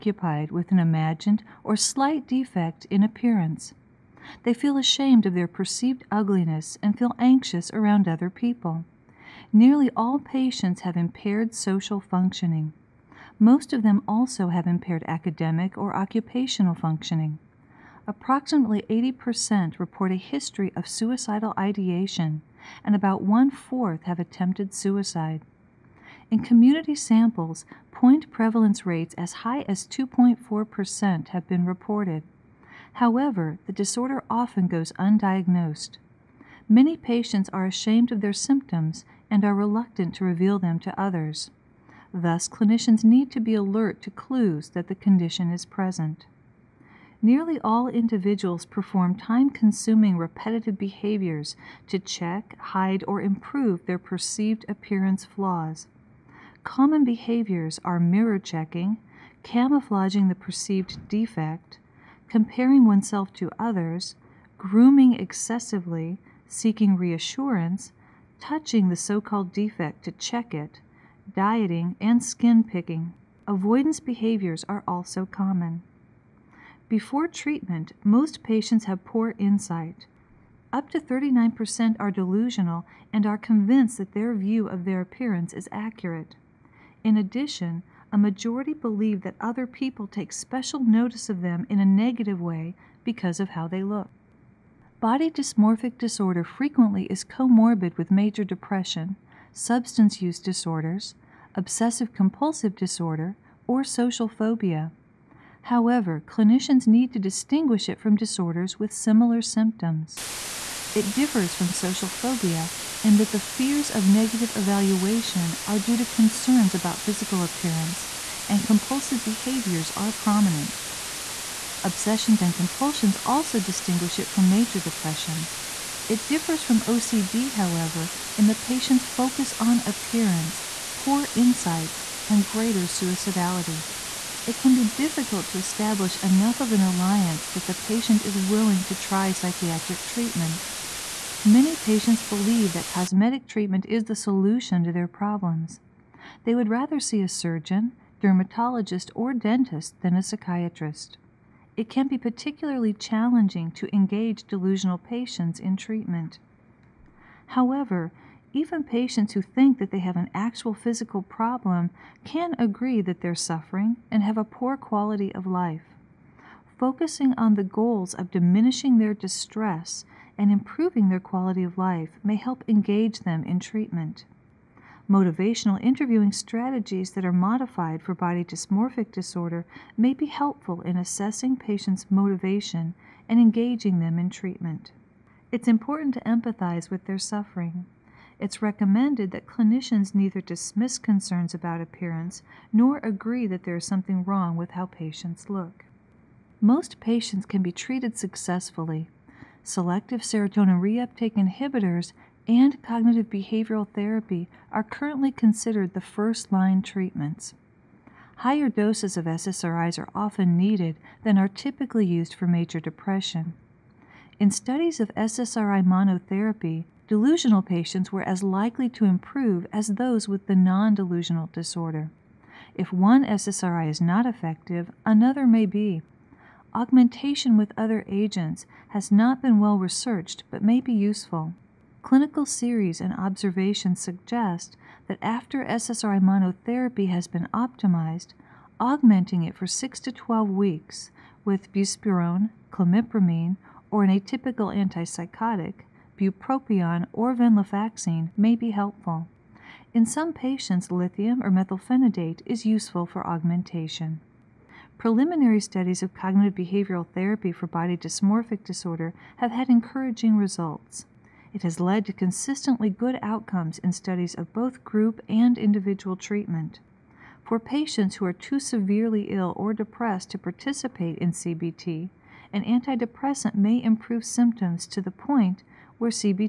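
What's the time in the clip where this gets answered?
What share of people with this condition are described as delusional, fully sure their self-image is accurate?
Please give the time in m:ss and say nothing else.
1:20.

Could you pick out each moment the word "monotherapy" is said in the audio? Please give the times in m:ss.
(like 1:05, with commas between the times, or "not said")
3:35, 3:56.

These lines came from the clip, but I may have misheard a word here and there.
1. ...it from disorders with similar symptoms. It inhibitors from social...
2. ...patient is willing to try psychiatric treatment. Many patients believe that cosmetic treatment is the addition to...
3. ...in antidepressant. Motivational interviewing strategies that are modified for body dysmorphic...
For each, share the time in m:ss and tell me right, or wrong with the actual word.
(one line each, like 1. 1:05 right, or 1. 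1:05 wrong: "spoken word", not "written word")
1. 1:47 wrong: "differs", not "inhibitors"
2. 2:17 wrong: "solution", not "addition"
3. 2:53 wrong: "treatment", not "antidepressant".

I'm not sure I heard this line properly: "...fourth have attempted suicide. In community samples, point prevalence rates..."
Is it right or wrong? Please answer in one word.
right.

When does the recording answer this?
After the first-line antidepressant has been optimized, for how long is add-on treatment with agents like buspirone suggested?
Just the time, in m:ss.
3:59.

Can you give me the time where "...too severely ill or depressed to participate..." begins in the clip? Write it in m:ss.
4:28.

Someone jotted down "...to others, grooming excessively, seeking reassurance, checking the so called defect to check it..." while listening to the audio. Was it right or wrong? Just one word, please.
wrong.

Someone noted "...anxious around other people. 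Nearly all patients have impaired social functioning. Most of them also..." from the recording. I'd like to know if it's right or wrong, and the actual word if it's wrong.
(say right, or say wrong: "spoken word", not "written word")
right.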